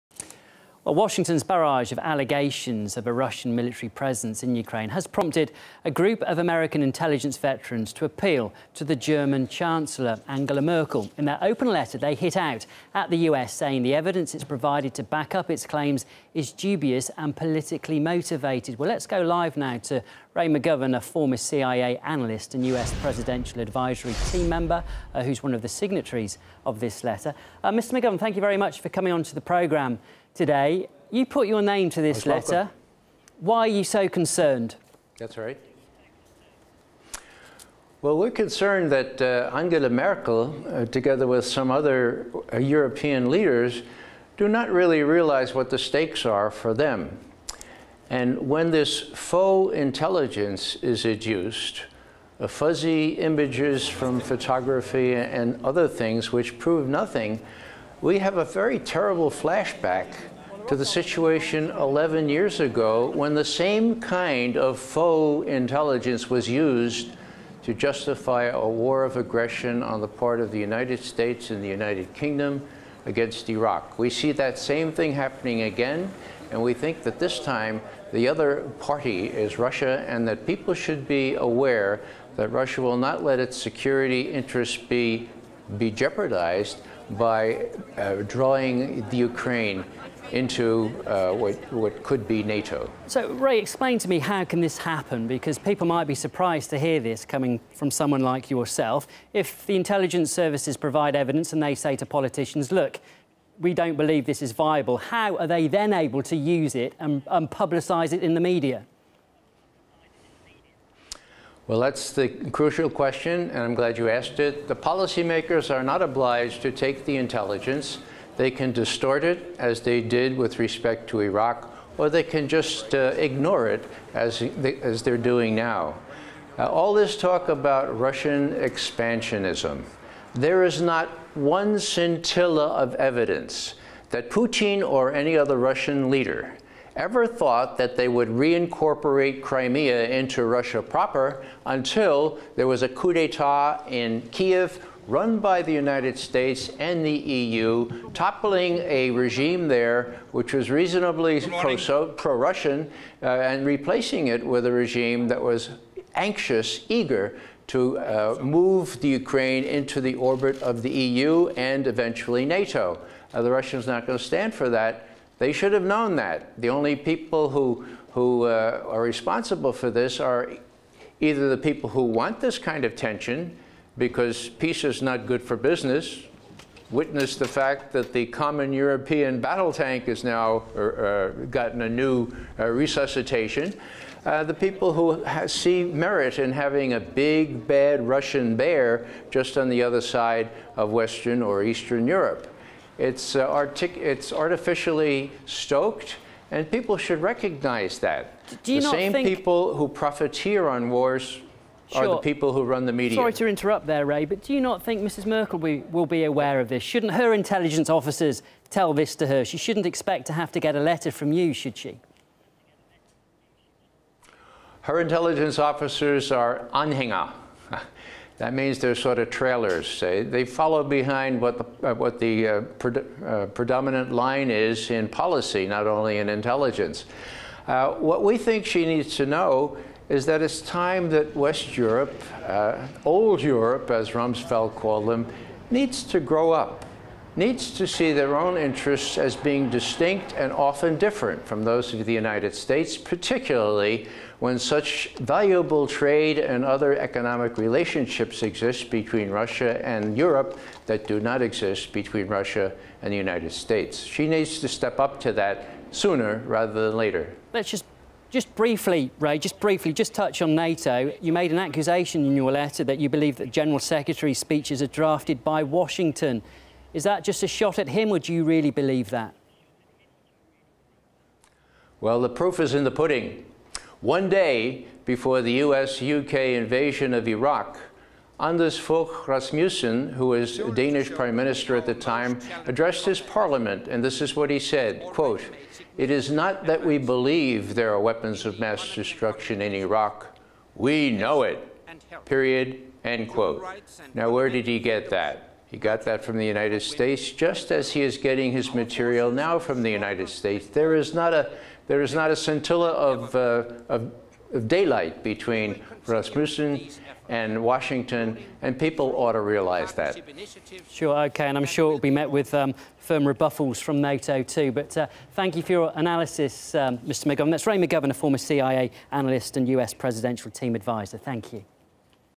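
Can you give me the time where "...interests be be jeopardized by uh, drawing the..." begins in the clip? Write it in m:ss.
1:24.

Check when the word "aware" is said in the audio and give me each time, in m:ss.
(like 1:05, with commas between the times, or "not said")
1:21, 3:26.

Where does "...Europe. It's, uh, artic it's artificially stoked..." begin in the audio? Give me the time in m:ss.
3:12.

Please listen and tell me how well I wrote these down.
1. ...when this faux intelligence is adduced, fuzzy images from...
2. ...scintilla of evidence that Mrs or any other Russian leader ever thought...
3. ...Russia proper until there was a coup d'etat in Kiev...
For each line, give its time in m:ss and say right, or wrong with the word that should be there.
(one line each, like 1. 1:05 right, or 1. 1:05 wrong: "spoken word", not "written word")
1. 0:48 right
2. 2:11 wrong: "Putin", not "Mrs"
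3. 2:20 right.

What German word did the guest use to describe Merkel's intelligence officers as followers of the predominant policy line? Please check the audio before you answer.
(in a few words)
anhänger.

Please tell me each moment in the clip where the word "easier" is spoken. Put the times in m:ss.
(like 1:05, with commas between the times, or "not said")
not said.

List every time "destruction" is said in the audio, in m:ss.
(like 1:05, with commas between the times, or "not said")
4:48.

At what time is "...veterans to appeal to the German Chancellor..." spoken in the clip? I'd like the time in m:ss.
0:07.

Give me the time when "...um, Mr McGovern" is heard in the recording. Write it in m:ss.
5:16.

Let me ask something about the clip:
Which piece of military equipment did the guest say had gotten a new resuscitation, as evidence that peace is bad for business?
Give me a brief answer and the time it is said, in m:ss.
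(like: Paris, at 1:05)
common European battle tank, at 2:58.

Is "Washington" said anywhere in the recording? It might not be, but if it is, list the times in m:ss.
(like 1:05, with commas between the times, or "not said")
0:00, 4:25, 5:07.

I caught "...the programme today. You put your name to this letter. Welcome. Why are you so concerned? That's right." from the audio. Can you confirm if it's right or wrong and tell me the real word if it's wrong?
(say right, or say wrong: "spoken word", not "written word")
right.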